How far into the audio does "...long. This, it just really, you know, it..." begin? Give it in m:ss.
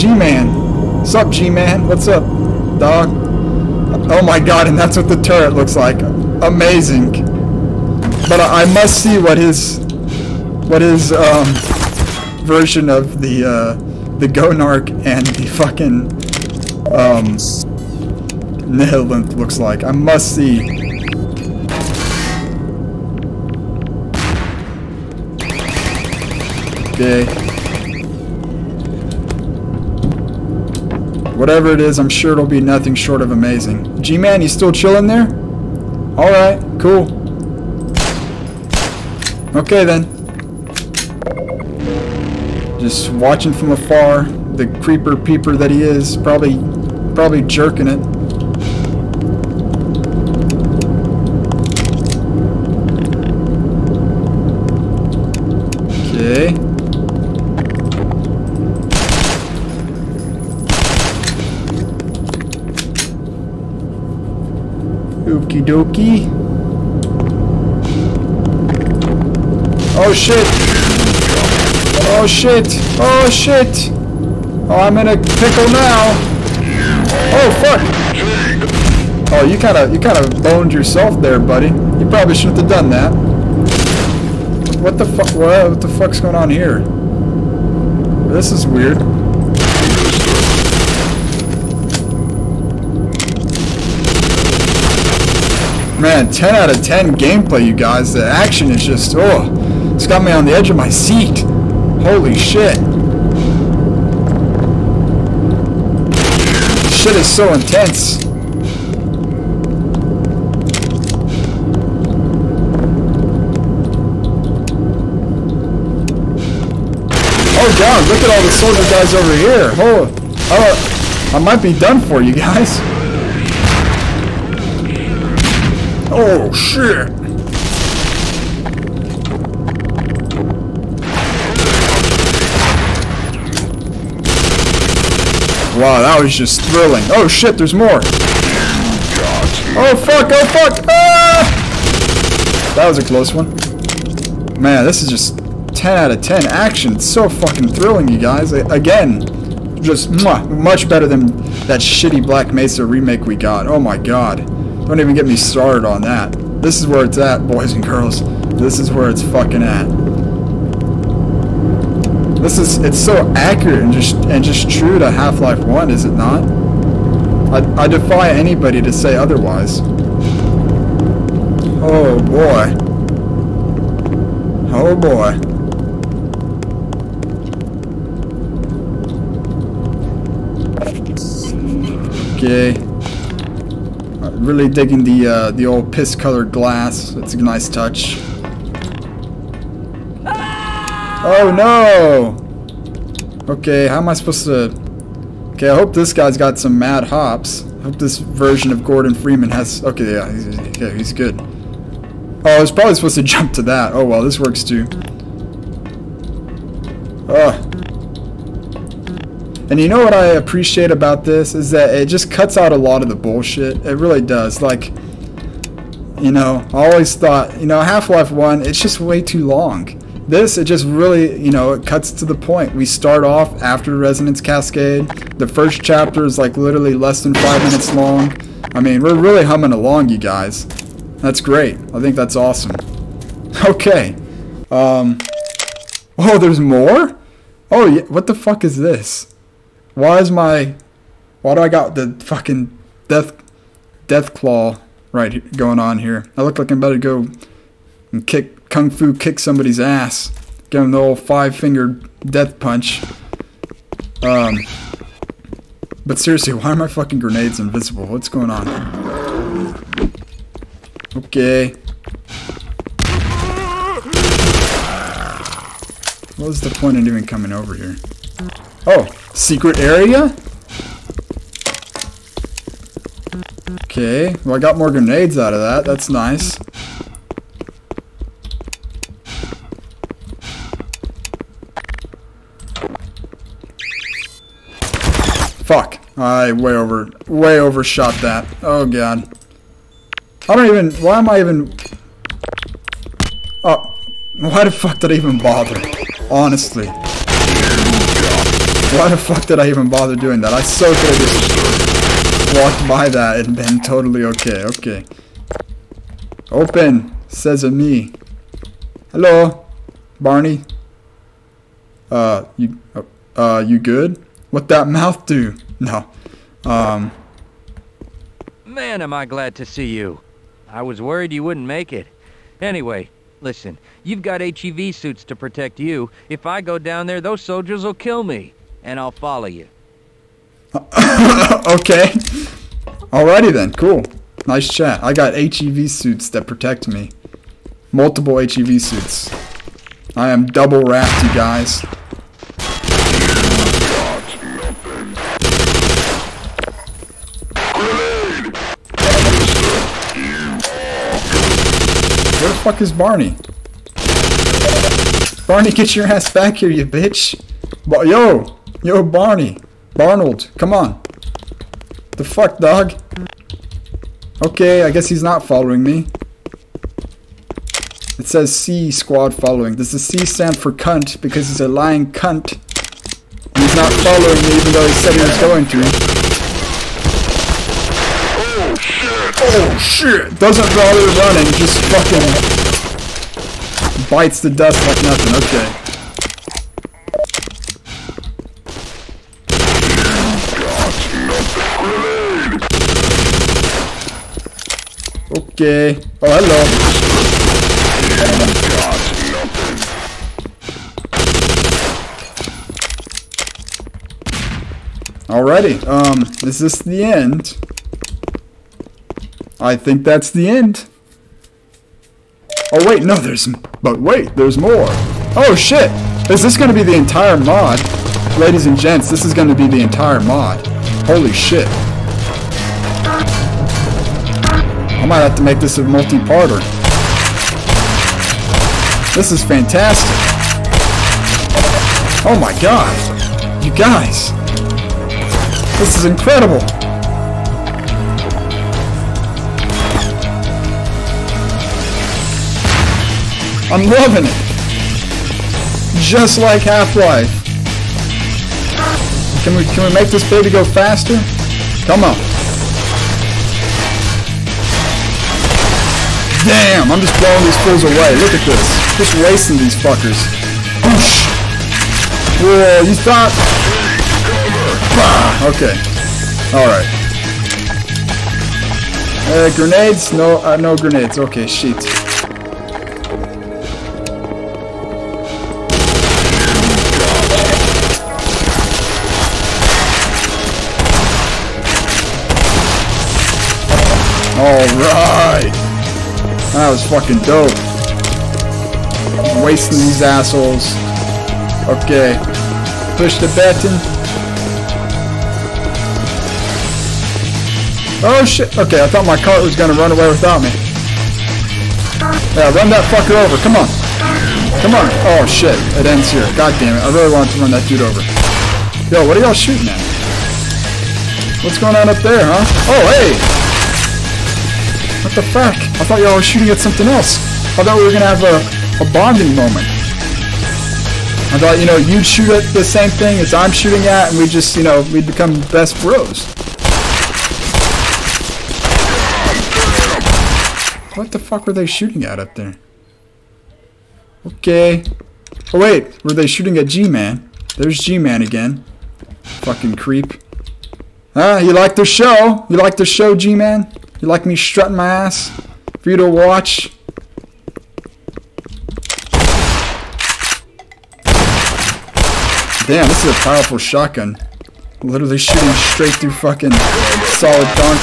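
3:39.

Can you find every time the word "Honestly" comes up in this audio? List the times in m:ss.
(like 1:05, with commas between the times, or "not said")
4:56.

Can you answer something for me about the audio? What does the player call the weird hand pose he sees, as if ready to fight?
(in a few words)
death claw.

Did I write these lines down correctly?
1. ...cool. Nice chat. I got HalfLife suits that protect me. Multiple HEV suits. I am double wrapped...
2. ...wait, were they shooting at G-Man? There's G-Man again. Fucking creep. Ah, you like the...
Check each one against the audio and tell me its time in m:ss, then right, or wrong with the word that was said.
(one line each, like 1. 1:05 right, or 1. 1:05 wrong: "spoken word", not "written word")
1. 5:33 wrong: "HEV", not "HalfLife"
2. 8:55 right.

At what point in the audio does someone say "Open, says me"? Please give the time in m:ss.
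5:06.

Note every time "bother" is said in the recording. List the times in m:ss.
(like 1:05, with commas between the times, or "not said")
4:55, 4:59, 6:20.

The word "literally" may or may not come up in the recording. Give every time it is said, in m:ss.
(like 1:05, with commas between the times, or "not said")
3:46, 9:14.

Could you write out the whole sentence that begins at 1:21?
You probably shouldn't have done that.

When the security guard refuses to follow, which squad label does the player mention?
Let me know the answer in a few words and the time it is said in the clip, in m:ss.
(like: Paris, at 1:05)
C squad, at 6:08.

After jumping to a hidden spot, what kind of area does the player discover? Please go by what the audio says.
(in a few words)
Secret area.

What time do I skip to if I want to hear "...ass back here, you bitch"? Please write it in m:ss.
5:56.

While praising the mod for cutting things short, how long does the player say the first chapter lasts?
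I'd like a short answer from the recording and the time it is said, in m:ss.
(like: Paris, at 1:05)
less than 5 minutes, at 3:46.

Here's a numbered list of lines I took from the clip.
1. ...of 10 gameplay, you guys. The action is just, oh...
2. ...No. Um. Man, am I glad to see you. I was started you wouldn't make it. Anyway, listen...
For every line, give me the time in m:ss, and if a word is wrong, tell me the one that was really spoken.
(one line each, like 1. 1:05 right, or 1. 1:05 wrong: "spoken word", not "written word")
1. 1:36 right
2. 5:15 wrong: "worried", not "started".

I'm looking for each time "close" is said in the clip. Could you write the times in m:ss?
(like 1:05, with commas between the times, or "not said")
2:23.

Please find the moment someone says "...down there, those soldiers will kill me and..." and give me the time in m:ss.
5:26.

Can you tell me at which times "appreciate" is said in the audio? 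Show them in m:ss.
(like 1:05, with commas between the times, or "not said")
3:30.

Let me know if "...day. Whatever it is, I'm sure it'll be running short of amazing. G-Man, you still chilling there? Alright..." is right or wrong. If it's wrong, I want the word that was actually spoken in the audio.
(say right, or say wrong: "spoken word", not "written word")
wrong: "nothing", not "running".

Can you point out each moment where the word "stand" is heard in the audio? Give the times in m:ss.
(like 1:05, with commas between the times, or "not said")
6:10.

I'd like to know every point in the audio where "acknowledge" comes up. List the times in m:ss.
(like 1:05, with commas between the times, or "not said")
not said.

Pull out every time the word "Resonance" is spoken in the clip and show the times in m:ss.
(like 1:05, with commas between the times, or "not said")
3:43.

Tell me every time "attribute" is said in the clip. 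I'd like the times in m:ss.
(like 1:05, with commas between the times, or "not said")
not said.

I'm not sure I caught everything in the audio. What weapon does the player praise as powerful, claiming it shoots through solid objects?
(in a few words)
shotgun.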